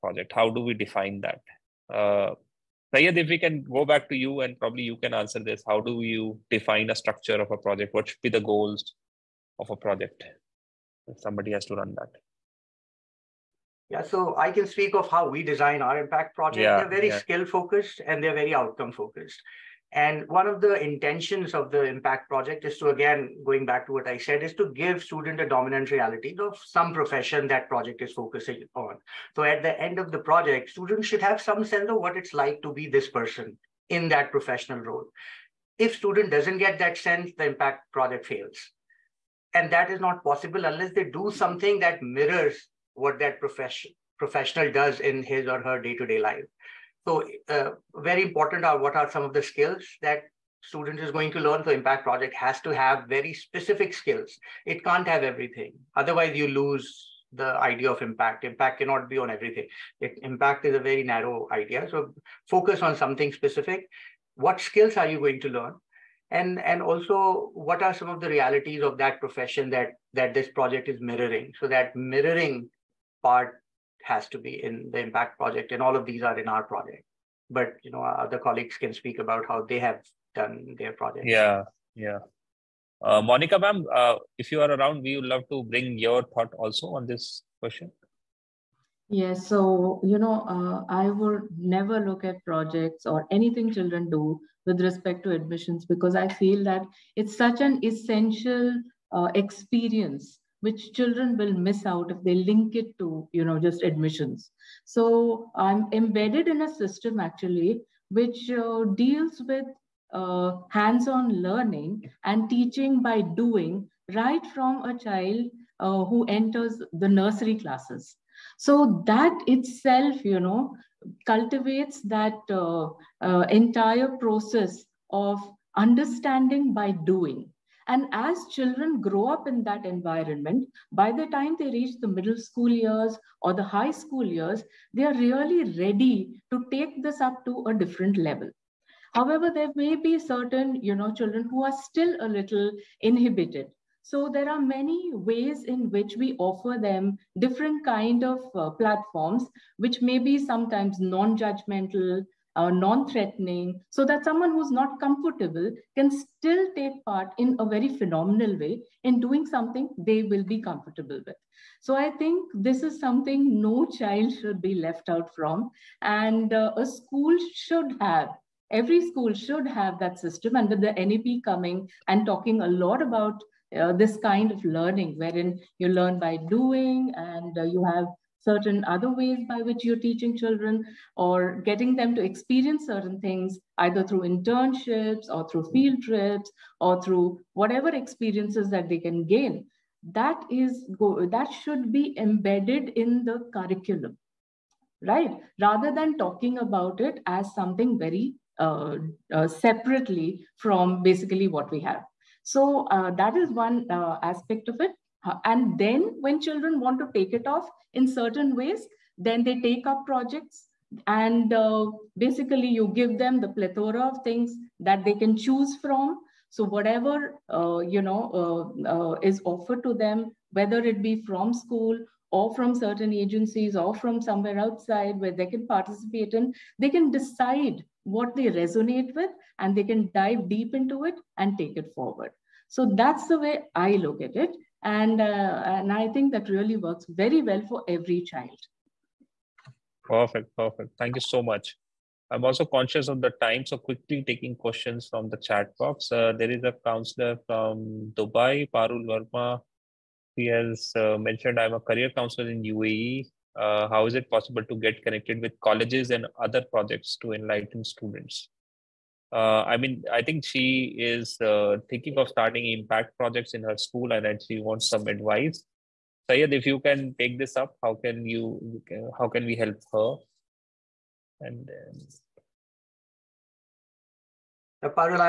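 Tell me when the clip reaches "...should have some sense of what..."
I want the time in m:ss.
0:31.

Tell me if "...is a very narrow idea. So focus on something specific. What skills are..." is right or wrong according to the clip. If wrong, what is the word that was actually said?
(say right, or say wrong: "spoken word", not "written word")
right.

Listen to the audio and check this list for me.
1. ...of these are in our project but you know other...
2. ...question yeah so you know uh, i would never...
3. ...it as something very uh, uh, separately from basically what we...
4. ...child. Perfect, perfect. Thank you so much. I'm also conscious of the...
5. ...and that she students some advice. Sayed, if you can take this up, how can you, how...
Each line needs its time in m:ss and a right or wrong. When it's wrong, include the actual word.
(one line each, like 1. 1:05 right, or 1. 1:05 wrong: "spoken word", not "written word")
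1. 1:15 right
2. 1:27 right
3. 3:16 right
4. 3:58 right
5. 4:24 wrong: "wants", not "students".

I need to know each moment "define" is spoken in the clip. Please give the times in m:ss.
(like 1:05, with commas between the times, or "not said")
0:00, 0:06.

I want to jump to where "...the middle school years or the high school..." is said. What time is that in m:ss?
2:11.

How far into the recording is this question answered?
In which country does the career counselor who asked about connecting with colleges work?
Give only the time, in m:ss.
4:12.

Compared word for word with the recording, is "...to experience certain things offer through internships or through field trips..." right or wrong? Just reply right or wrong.
wrong.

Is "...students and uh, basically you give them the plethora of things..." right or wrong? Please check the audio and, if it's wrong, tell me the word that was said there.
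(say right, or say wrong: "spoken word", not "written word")
wrong: "projects", not "students".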